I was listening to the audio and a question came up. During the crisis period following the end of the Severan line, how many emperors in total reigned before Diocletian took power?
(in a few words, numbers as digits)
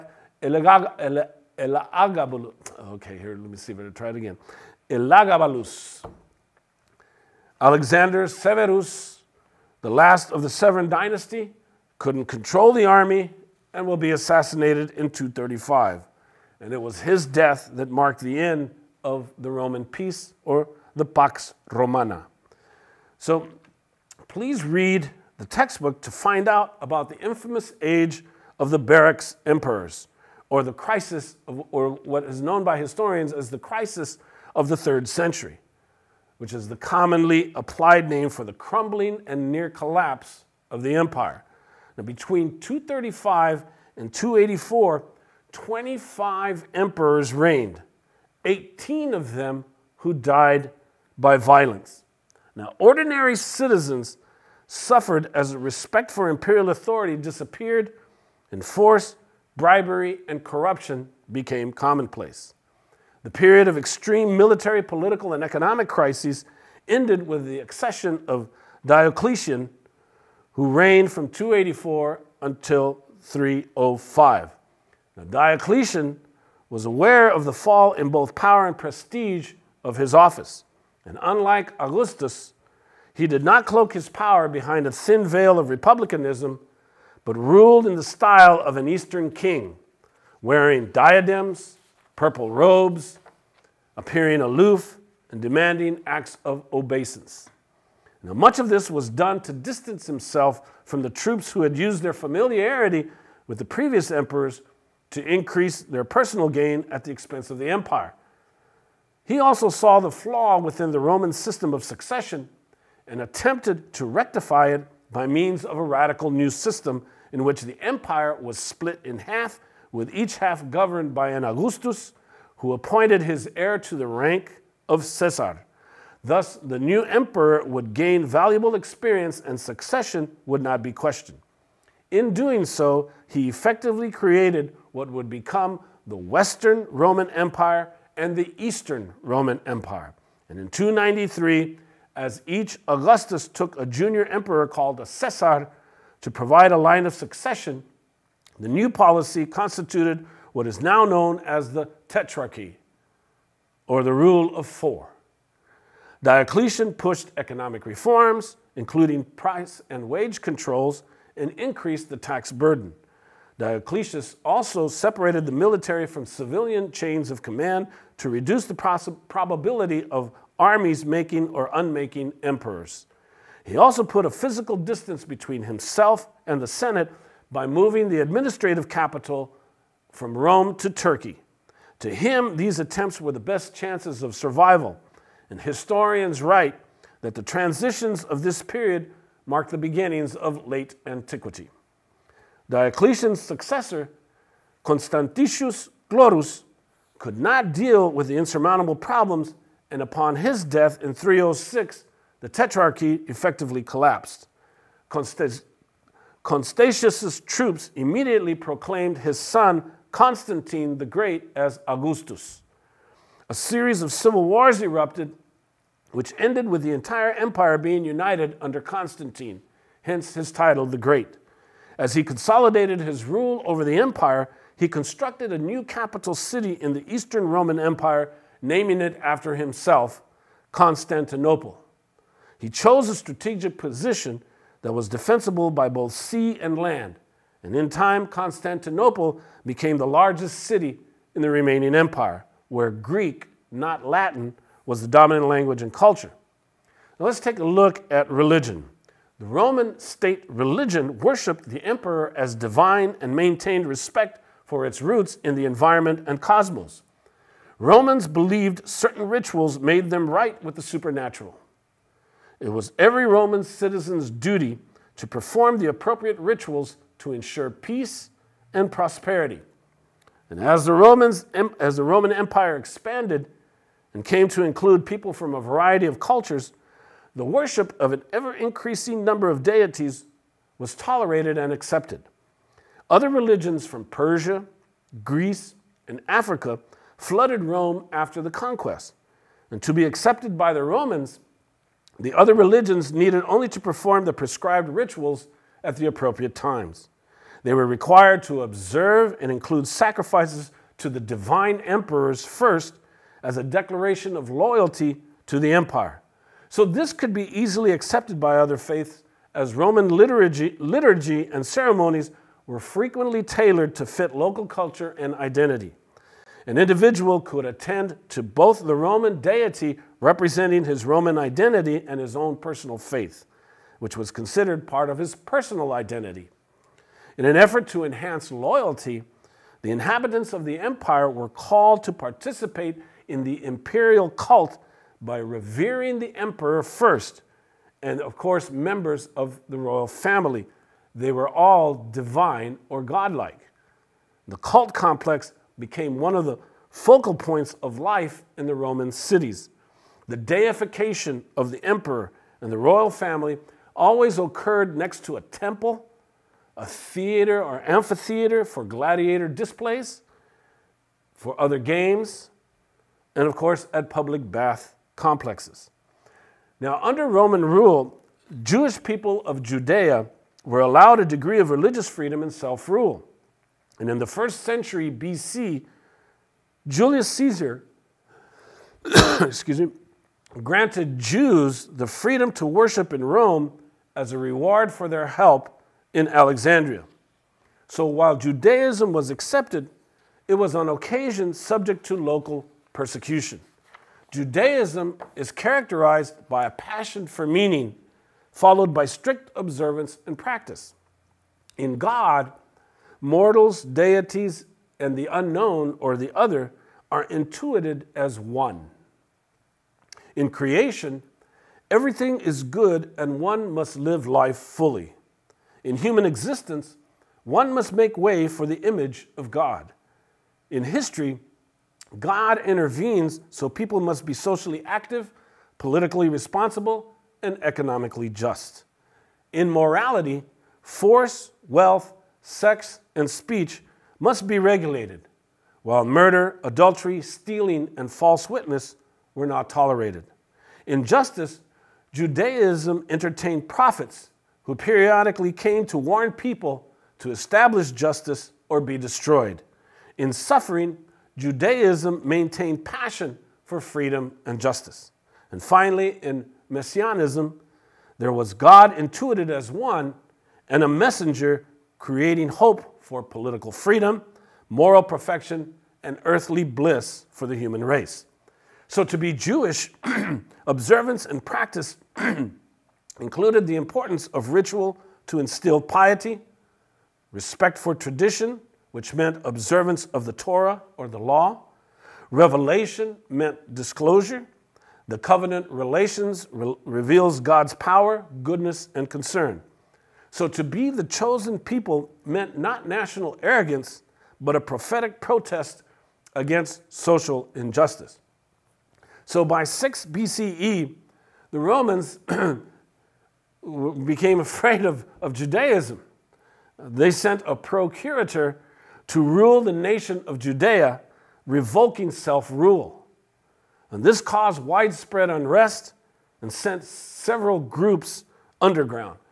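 25.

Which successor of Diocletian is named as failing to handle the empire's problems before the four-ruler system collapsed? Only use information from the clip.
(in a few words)
Constantius Chlorus.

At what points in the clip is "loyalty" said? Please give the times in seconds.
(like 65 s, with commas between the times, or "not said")
304 s, 328 s.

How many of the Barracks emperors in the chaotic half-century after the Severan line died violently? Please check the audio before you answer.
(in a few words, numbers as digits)
18.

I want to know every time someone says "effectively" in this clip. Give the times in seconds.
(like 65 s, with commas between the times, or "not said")
133 s, 203 s.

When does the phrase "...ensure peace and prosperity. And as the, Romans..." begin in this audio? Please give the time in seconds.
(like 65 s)
267 s.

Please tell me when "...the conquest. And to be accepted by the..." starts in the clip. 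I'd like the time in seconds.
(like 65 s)
288 s.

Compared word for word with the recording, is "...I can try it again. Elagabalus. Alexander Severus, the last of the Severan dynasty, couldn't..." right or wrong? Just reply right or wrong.
right.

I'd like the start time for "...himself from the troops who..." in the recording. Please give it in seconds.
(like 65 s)
100 s.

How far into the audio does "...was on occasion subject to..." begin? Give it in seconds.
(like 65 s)
390 s.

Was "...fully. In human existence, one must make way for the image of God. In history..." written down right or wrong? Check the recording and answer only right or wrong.
right.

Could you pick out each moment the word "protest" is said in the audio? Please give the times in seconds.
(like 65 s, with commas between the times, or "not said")
495 s.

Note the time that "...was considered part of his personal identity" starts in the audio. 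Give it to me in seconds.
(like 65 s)
324 s.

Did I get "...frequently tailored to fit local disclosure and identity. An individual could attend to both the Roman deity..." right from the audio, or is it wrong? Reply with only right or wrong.
wrong.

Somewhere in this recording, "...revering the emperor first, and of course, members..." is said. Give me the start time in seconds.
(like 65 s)
335 s.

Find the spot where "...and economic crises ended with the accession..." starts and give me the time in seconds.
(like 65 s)
65 s.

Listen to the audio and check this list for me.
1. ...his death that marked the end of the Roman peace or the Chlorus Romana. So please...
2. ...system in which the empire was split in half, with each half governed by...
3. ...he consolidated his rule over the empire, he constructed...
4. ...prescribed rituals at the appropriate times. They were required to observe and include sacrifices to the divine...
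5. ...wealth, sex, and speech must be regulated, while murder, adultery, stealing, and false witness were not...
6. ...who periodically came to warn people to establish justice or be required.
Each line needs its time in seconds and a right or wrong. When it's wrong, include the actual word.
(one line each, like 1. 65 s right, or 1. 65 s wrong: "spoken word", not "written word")
1. 17 s wrong: "Pax", not "Chlorus"
2. 116 s right
3. 222 s right
4. 294 s right
5. 431 s right
6. 444 s wrong: "destroyed", not "required".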